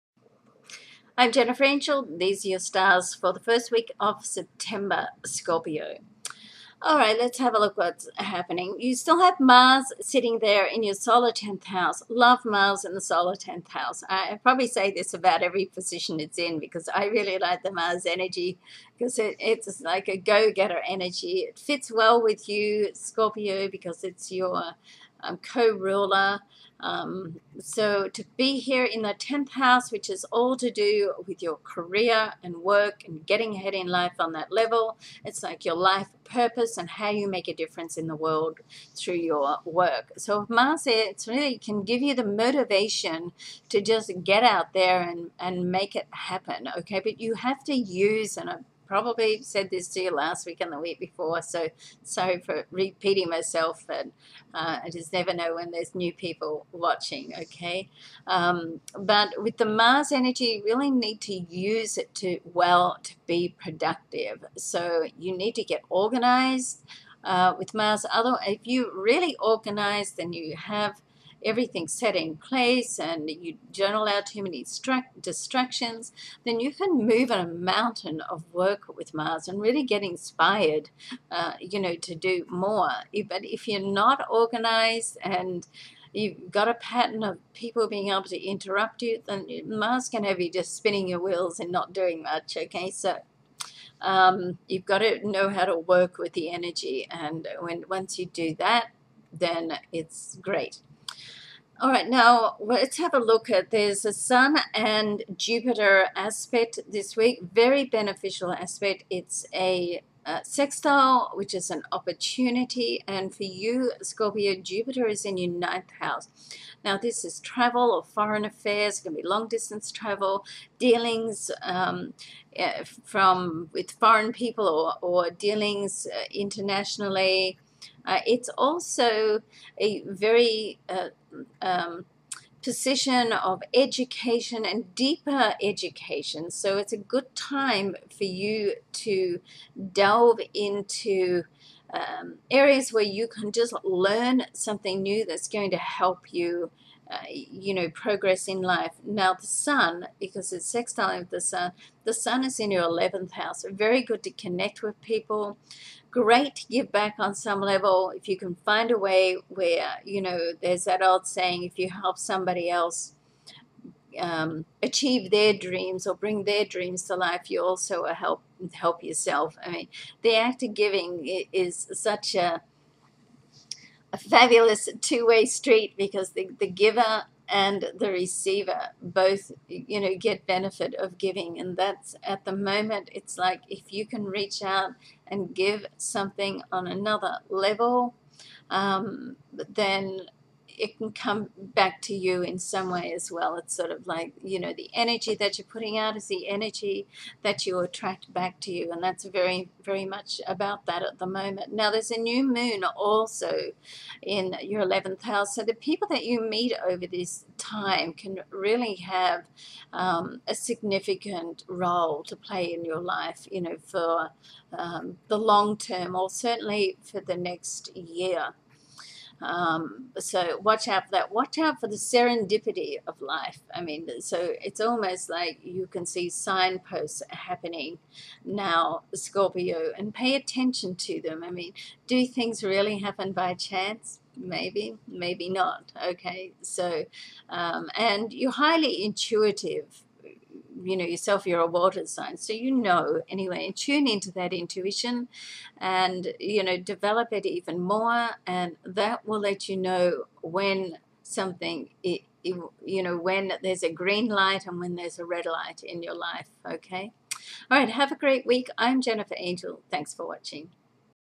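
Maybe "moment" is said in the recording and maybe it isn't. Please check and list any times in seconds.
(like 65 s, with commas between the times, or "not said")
182 s, 201 s.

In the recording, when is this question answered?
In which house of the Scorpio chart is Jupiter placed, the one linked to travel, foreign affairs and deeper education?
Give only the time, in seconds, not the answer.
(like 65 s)
115 s.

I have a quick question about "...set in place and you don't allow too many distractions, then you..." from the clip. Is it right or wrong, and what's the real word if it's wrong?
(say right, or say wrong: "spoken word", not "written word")
right.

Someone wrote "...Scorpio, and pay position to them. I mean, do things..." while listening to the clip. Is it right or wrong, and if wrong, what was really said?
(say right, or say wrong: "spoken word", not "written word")
wrong: "attention", not "position".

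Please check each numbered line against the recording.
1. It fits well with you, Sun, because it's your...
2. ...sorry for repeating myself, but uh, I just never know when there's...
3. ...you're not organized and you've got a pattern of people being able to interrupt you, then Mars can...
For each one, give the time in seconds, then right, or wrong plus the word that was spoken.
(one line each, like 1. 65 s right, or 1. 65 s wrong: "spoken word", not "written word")
1. 21 s wrong: "Scorpio", not "Sun"
2. 52 s right
3. 83 s right.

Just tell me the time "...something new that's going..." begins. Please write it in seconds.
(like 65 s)
144 s.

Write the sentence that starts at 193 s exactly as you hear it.
It's sort of like, you know, the energy that you're putting out is the energy that you attract back to you.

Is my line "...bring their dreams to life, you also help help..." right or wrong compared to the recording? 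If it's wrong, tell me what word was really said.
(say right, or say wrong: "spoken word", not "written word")
right.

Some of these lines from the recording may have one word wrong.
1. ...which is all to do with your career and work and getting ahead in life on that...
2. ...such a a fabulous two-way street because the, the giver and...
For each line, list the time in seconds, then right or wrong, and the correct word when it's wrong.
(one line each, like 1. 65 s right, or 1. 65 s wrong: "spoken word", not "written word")
1. 29 s right
2. 171 s right.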